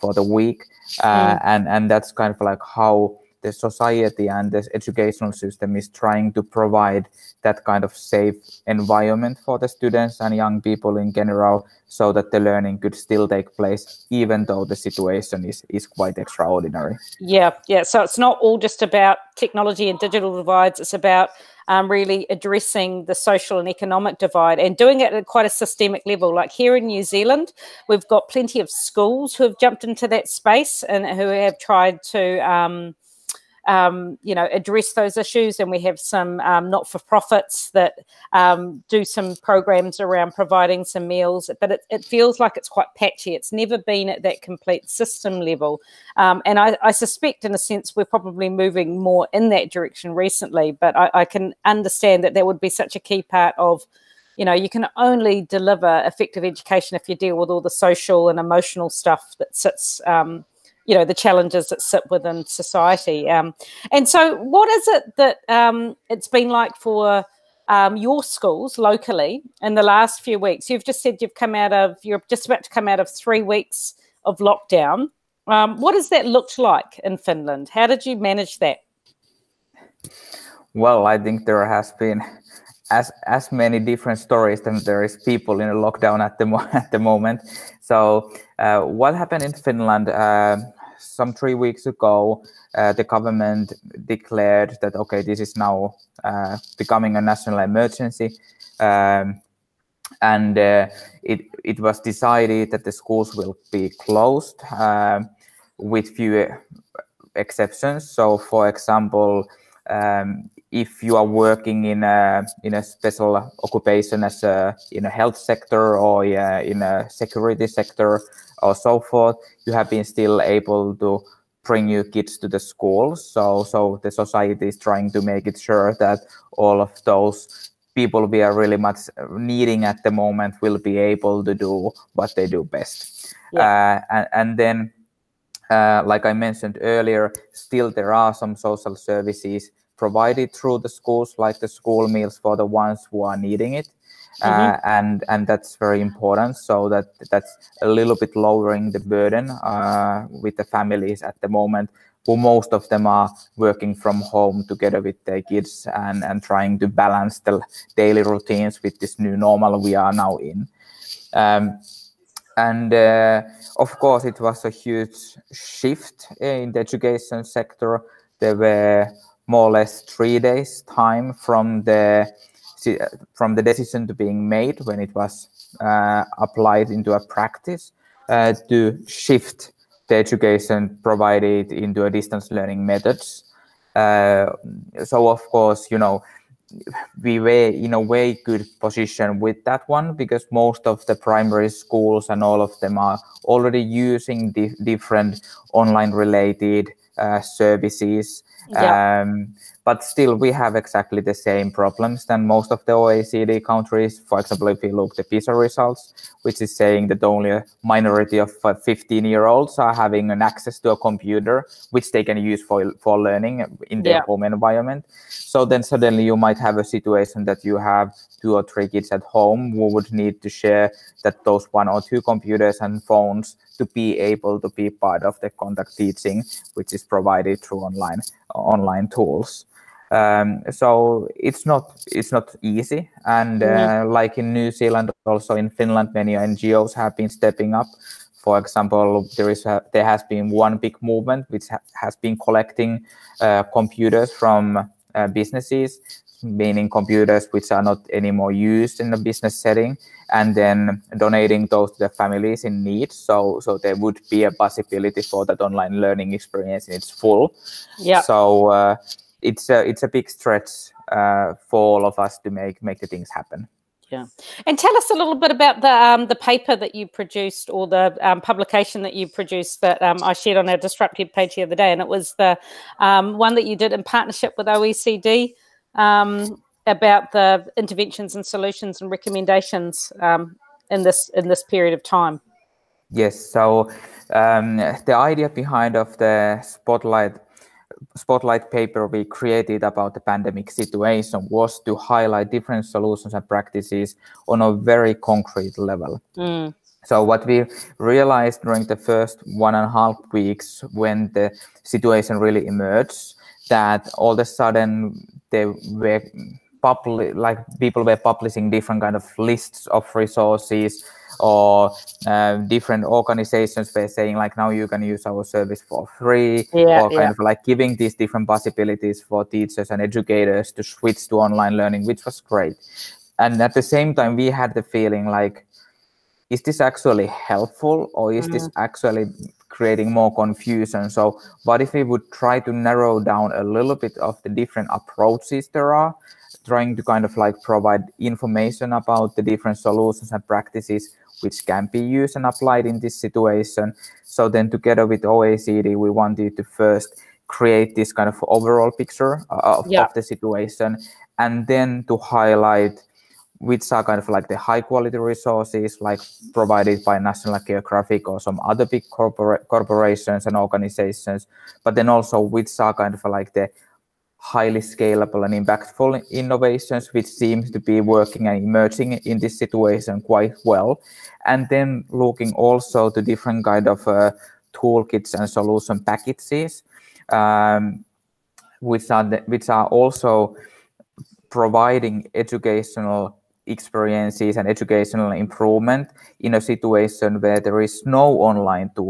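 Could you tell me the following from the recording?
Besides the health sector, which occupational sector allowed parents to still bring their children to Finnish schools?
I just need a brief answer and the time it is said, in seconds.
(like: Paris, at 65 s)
security sector, at 117 s.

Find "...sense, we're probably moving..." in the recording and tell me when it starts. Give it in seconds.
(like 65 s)
47 s.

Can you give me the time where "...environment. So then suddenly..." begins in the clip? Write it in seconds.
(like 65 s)
214 s.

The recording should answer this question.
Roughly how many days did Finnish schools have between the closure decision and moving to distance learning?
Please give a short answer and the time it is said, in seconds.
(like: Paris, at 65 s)
3, at 170 s.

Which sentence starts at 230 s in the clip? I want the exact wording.
Um, so it's not it's not easy, and uh, like in New Zealand, also in Finland, many NGOs have been stepping up.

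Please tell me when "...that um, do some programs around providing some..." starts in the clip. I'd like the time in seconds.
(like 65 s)
37 s.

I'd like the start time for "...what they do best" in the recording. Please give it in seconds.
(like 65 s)
132 s.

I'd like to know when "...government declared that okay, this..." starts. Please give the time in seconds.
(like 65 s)
93 s.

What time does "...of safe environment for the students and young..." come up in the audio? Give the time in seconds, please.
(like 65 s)
7 s.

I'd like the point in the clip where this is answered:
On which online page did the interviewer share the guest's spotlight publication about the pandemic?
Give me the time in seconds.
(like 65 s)
270 s.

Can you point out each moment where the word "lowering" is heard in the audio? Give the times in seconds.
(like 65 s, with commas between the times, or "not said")
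148 s.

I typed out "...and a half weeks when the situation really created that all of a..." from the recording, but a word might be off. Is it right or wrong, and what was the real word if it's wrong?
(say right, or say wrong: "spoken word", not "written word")
wrong: "emerged", not "created".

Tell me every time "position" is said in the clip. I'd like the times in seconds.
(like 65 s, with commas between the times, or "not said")
188 s.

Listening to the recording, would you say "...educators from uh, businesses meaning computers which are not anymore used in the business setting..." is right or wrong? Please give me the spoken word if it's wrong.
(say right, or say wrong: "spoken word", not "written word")
wrong: "computers", not "educators".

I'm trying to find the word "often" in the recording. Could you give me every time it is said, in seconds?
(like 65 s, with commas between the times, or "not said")
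not said.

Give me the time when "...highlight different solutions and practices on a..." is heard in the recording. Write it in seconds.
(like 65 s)
291 s.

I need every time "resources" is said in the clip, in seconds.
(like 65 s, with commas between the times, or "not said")
310 s, 355 s.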